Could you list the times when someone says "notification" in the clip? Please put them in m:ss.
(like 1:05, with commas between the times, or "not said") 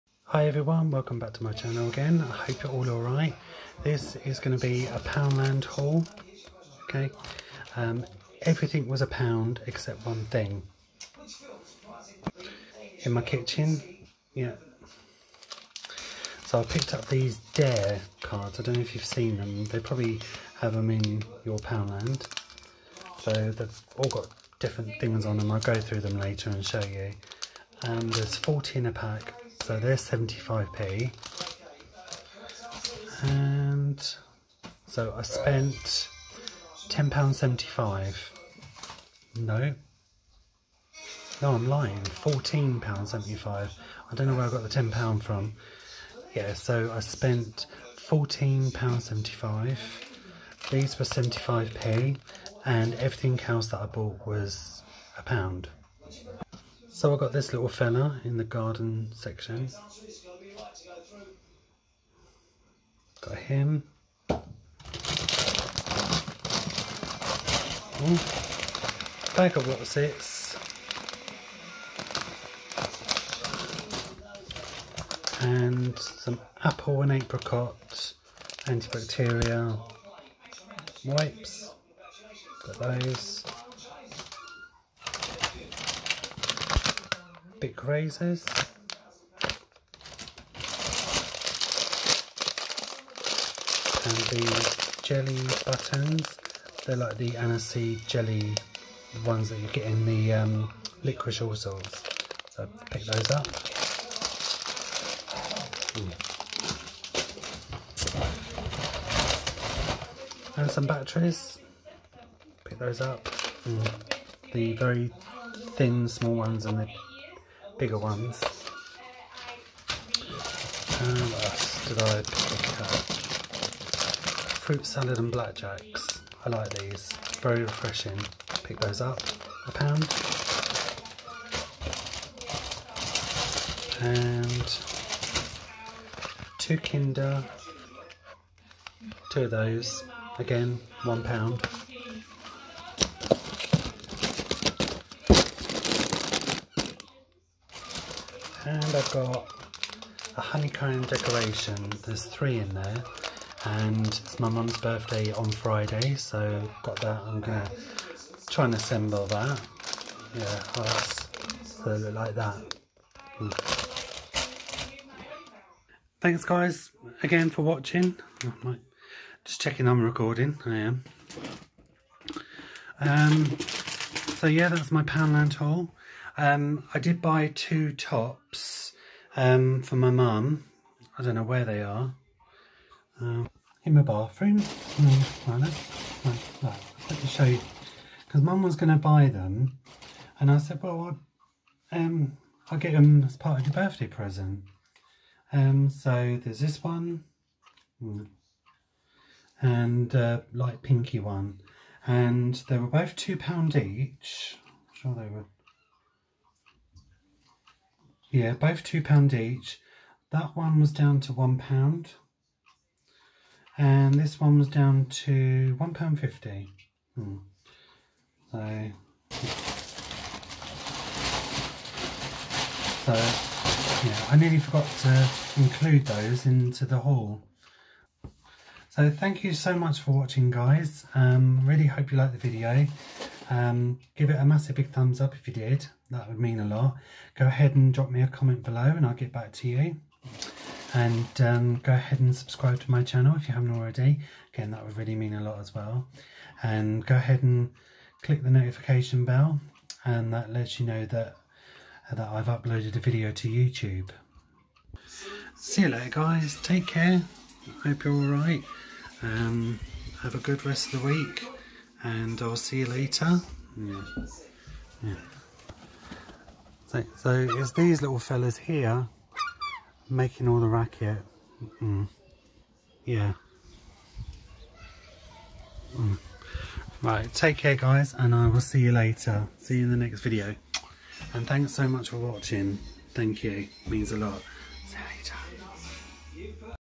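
4:08.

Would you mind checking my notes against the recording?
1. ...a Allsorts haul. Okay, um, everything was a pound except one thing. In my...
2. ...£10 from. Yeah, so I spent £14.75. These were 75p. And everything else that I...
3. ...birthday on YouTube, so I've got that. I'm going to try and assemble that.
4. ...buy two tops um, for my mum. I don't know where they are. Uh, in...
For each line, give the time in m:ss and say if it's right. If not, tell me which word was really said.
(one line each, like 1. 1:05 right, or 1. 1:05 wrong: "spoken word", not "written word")
1. 0:04 wrong: "Poundland", not "Allsorts"
2. 0:44 right
3. 2:34 wrong: "Friday", not "YouTube"
4. 2:57 right.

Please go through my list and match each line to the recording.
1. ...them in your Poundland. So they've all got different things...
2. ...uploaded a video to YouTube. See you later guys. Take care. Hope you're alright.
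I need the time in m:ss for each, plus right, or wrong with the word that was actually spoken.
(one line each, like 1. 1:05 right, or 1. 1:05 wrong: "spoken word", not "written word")
1. 0:20 right
2. 4:12 right.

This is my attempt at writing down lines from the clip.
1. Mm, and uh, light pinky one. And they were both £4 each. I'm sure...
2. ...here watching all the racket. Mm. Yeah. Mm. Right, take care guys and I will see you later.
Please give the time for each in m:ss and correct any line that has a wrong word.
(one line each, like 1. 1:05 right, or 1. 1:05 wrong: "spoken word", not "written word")
1. 3:18 wrong: "2", not "4"
2. 4:28 wrong: "making", not "watching".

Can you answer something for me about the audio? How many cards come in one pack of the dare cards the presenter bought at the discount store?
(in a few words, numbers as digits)
40.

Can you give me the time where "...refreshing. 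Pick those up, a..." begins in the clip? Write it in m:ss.
2:07.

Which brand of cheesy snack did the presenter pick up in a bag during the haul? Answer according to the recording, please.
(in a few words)
Wotsits.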